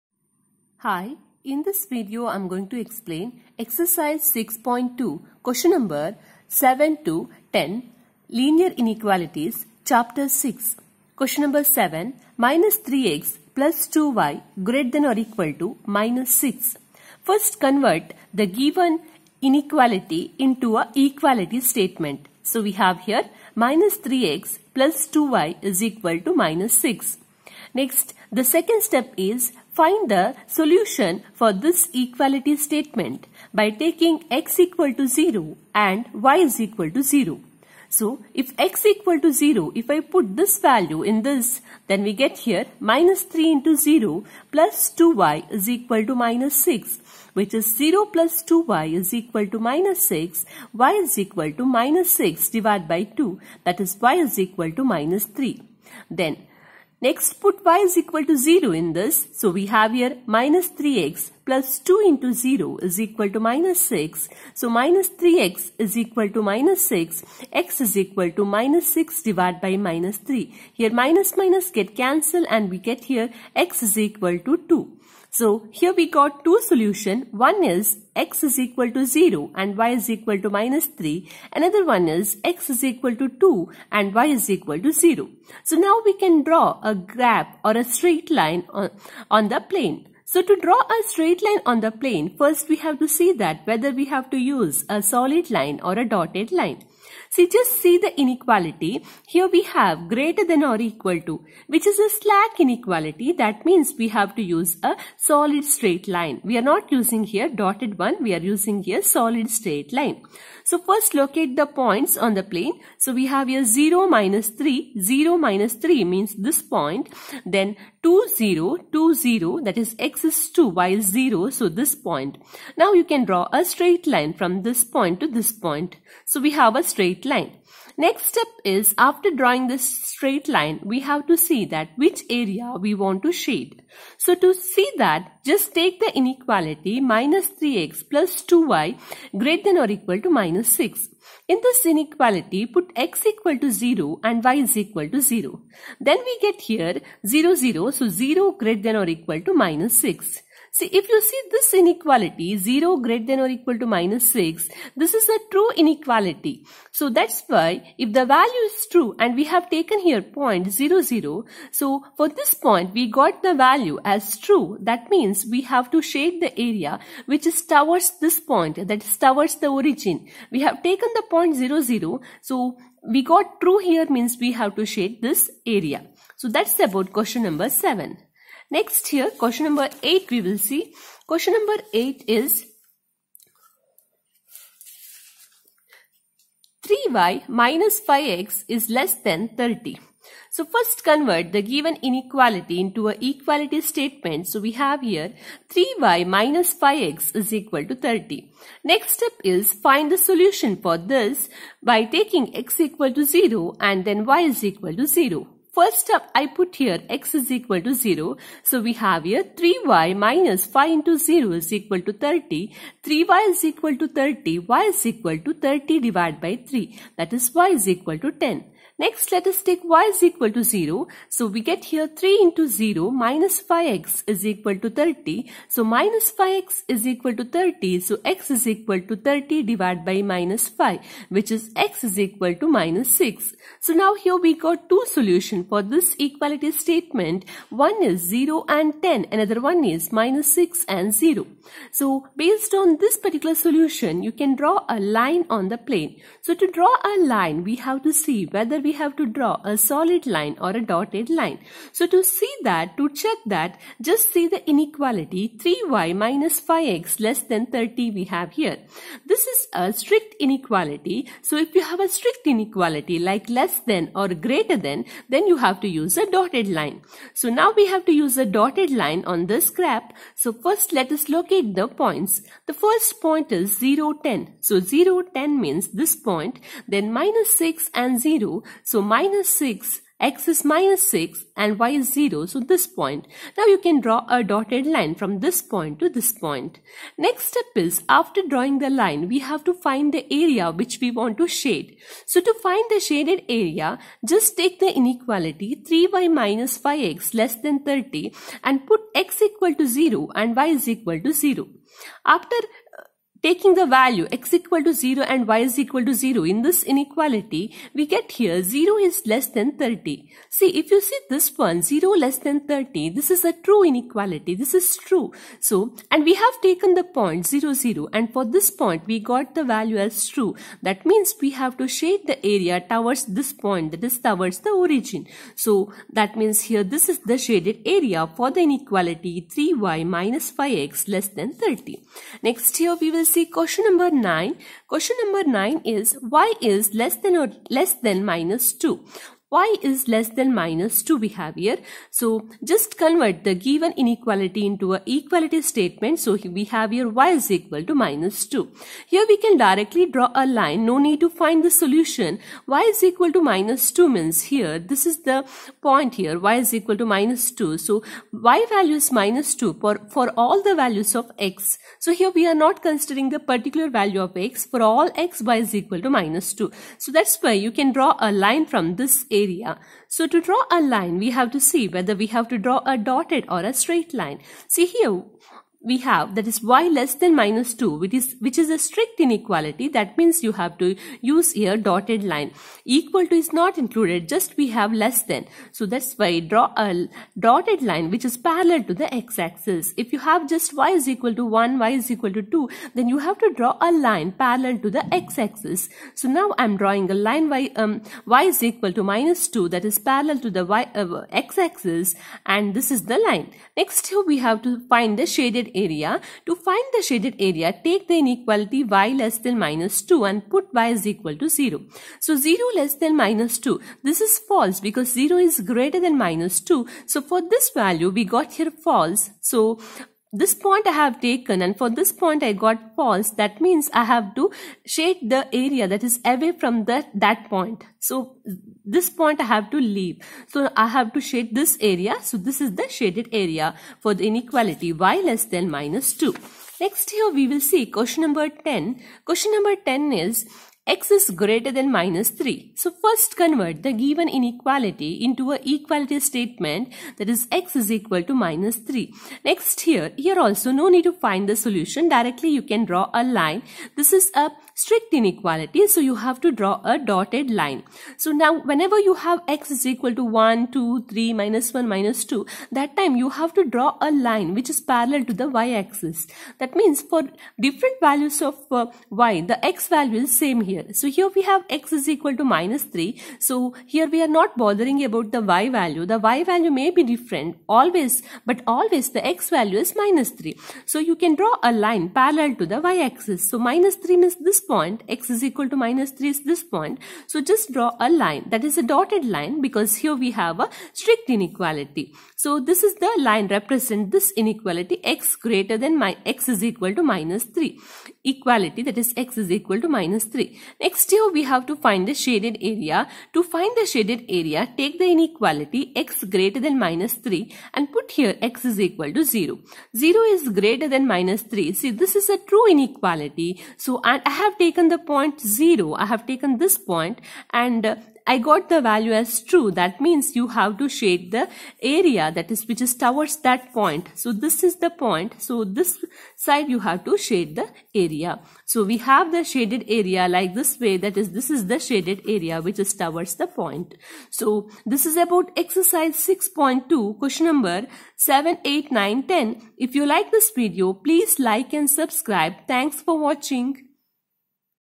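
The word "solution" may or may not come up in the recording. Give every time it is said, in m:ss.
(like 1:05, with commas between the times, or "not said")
0:30, 1:16, 3:20, 3:55, 4:03, 5:51, 7:31.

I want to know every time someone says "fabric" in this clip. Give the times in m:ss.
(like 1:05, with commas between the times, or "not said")
not said.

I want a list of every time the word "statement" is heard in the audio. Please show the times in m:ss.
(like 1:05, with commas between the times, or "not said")
0:21, 0:32, 3:13, 3:56, 5:45, 7:26.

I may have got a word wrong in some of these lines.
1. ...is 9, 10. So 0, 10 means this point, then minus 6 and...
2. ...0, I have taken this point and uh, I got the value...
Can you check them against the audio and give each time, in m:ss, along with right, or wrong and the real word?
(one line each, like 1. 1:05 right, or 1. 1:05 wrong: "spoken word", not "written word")
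1. 4:33 wrong: "0", not "9"
2. 8:35 right.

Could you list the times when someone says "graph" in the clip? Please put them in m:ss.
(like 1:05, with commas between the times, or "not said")
1:26, 4:29.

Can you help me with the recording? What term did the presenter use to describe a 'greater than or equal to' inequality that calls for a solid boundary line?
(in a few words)
slack inequality.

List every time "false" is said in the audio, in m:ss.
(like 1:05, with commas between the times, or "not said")
6:54, 6:58, 7:02.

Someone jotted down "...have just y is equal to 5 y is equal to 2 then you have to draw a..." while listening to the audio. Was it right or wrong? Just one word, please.
wrong.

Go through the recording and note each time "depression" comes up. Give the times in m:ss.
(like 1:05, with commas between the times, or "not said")
not said.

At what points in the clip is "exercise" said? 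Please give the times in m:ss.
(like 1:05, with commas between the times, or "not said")
0:03, 8:55.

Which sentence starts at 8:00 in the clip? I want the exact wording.
So you can draw a line parallel to the y axis.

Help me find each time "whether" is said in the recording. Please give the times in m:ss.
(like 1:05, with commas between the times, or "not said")
1:33, 4:08, 6:11.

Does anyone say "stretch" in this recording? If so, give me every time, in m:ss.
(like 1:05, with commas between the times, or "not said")
not said.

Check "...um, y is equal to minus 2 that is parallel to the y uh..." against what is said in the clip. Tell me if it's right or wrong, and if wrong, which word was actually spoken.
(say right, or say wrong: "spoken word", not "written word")
right.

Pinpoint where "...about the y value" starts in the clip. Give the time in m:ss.
7:55.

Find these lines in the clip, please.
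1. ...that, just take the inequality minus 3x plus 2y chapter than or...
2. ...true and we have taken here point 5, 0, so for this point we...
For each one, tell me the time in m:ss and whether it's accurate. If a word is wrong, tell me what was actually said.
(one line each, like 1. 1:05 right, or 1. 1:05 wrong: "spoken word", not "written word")
1. 2:14 wrong: "greater", not "chapter"
2. 2:38 wrong: "0", not "5".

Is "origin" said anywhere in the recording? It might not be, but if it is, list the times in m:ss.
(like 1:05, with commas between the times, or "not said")
2:49, 5:24.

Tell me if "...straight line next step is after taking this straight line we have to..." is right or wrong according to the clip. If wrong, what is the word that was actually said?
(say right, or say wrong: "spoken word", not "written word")
wrong: "drawing", not "taking".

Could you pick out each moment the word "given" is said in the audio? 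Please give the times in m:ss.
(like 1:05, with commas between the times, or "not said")
0:18, 3:11, 5:43, 7:23.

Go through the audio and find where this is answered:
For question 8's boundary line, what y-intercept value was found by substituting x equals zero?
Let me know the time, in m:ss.
3:37.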